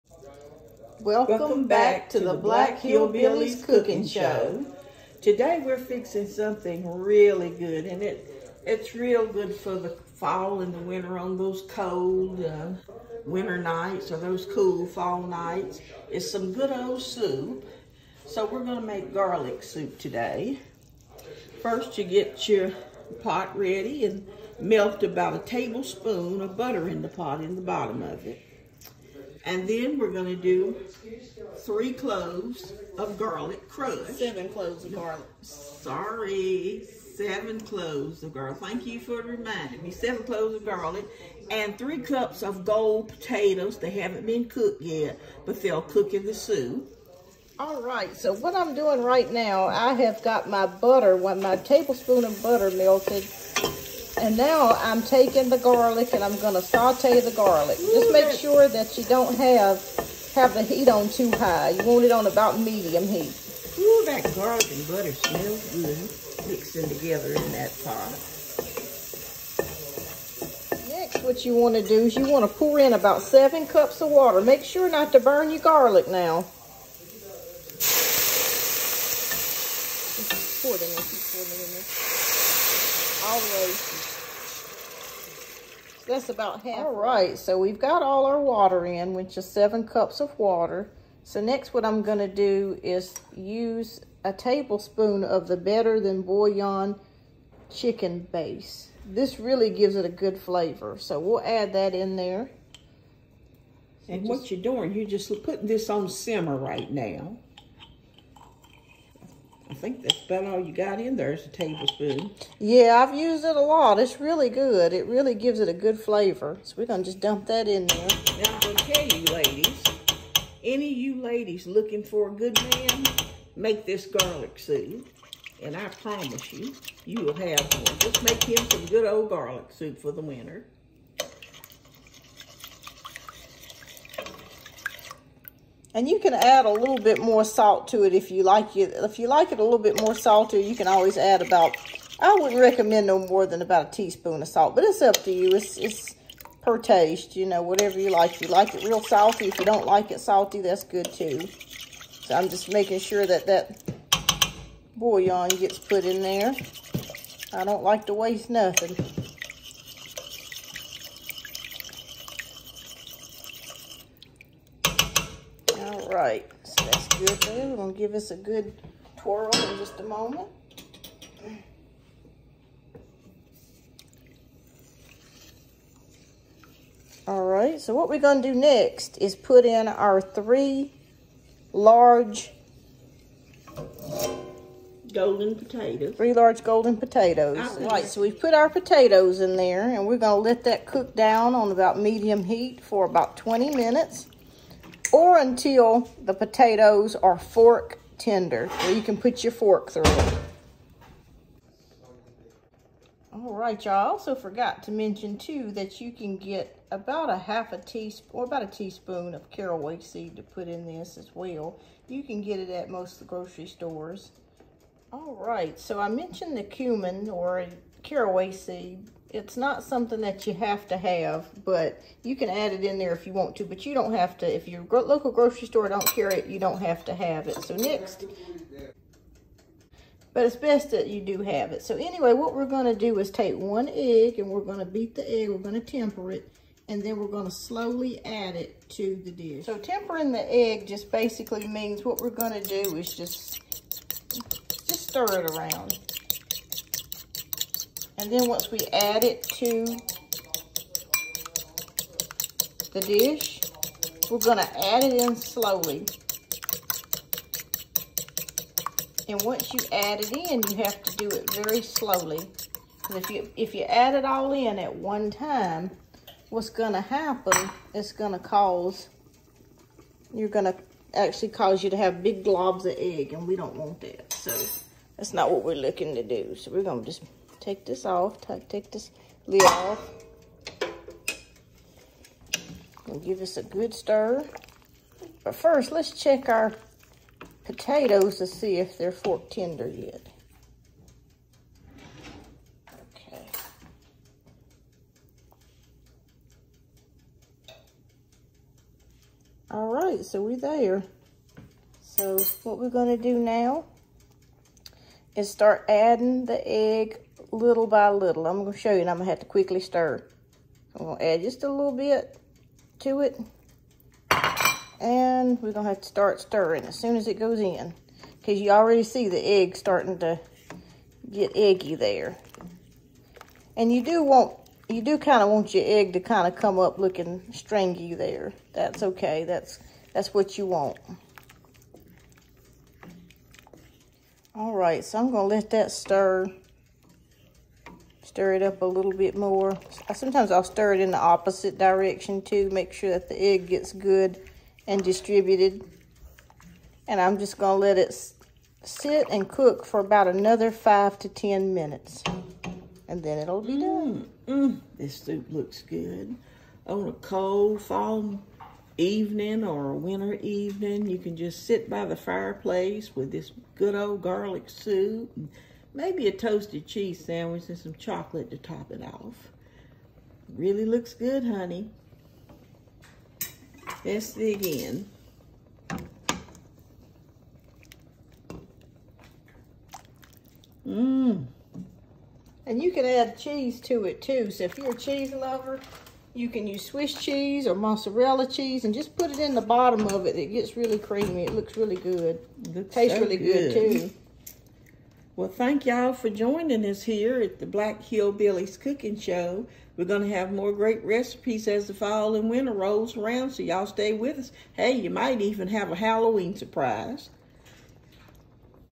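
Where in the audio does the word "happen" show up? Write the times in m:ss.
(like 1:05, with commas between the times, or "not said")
4:27.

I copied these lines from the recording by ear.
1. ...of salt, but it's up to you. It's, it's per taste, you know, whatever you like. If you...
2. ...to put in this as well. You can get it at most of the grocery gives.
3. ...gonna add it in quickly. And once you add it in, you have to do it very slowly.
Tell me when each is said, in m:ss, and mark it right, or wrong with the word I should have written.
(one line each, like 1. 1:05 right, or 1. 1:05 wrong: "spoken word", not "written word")
1. 2:24 right
2. 3:30 wrong: "stores", not "gives"
3. 4:14 wrong: "slowly", not "quickly".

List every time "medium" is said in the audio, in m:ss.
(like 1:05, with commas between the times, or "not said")
1:02, 3:11.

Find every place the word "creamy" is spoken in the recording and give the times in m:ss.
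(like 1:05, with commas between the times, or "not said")
6:30.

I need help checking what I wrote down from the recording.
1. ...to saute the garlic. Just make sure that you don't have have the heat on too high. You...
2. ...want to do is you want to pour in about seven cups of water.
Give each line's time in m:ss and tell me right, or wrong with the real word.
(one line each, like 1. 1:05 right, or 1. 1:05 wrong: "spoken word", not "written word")
1. 0:56 right
2. 1:11 right.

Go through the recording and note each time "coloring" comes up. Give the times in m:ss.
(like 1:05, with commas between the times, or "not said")
not said.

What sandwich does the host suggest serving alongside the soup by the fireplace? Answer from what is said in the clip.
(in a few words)
Toasted cheese sandwich.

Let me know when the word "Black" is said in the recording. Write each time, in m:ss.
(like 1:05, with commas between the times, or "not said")
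0:02, 6:37.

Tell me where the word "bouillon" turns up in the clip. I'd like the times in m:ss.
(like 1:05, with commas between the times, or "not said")
1:36, 2:34.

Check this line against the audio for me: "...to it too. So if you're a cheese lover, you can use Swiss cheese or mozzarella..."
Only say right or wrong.
right.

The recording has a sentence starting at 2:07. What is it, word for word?
Just make him some good old garlic soup for the winter.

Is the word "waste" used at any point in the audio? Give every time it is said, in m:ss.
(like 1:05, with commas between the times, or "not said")
2:38.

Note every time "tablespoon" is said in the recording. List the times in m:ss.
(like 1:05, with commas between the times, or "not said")
0:25, 0:51, 1:34, 1:51.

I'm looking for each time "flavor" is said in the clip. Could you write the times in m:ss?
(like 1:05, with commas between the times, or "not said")
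1:40, 1:55.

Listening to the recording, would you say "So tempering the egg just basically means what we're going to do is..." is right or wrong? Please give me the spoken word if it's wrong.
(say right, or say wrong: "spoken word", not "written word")
right.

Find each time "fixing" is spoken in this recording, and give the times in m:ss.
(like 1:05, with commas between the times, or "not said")
0:05.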